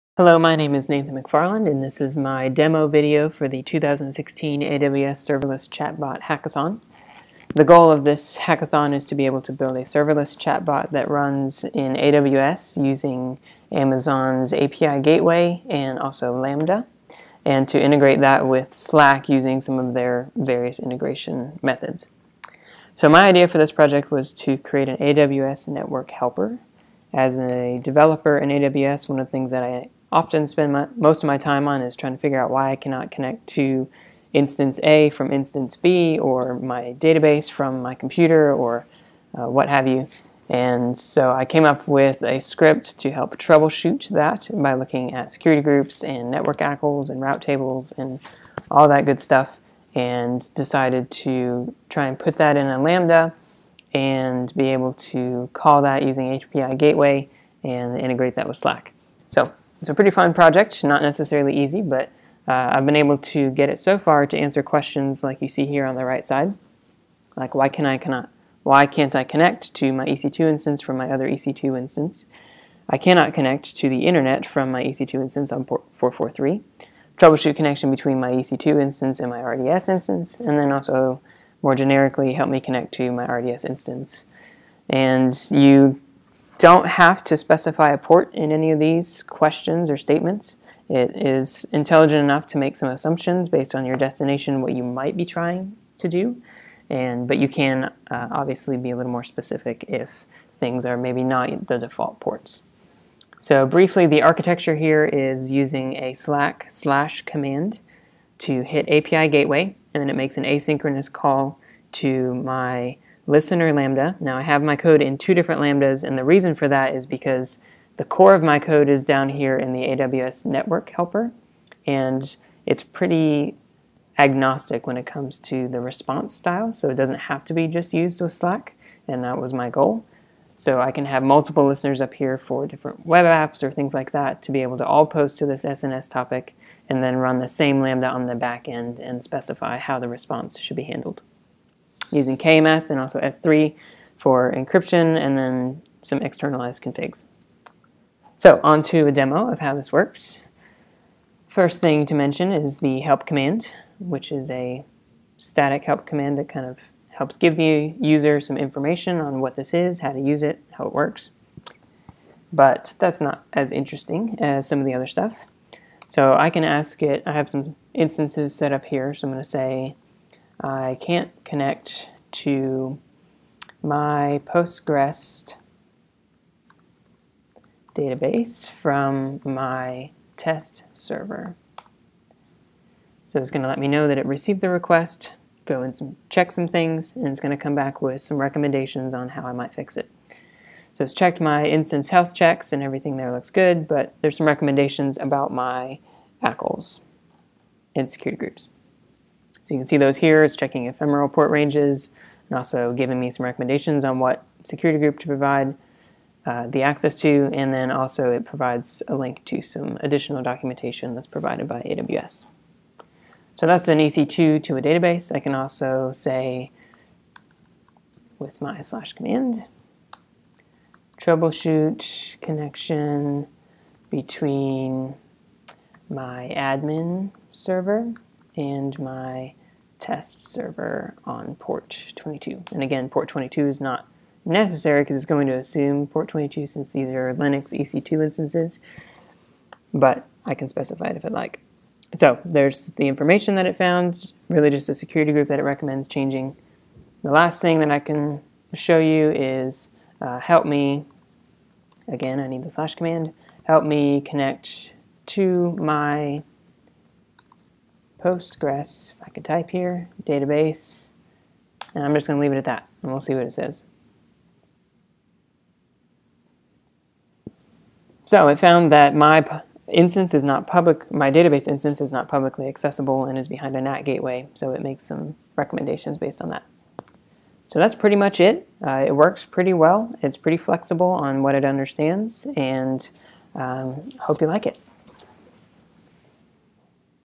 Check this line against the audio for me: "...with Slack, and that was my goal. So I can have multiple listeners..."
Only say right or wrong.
right.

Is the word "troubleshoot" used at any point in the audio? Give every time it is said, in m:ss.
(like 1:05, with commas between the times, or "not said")
0:43, 1:17, 3:41.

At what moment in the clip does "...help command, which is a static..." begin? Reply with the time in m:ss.
2:33.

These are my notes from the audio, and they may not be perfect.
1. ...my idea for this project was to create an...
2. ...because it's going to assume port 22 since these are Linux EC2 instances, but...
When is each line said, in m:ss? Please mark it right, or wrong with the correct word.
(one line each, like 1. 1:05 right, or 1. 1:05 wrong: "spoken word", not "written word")
1. 0:23 right
2. 3:55 right.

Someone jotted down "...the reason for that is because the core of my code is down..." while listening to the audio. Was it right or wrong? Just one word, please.
right.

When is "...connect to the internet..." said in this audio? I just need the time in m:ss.
1:13.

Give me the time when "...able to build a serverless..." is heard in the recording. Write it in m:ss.
0:09.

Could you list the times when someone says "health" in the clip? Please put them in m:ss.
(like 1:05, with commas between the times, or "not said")
3:12.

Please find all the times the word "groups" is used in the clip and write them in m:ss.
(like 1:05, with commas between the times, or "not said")
0:45, 3:18, 3:24, 4:05.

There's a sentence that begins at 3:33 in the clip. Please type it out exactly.
So that's an EC2 to a database.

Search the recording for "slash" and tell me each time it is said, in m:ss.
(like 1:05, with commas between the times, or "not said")
1:46, 3:38, 4:12.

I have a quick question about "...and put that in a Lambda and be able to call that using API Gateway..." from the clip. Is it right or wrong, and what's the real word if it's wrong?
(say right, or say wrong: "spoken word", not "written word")
right.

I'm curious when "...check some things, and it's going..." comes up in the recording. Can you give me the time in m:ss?
3:06.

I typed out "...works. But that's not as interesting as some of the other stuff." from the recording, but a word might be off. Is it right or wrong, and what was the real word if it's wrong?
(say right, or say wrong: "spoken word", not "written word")
right.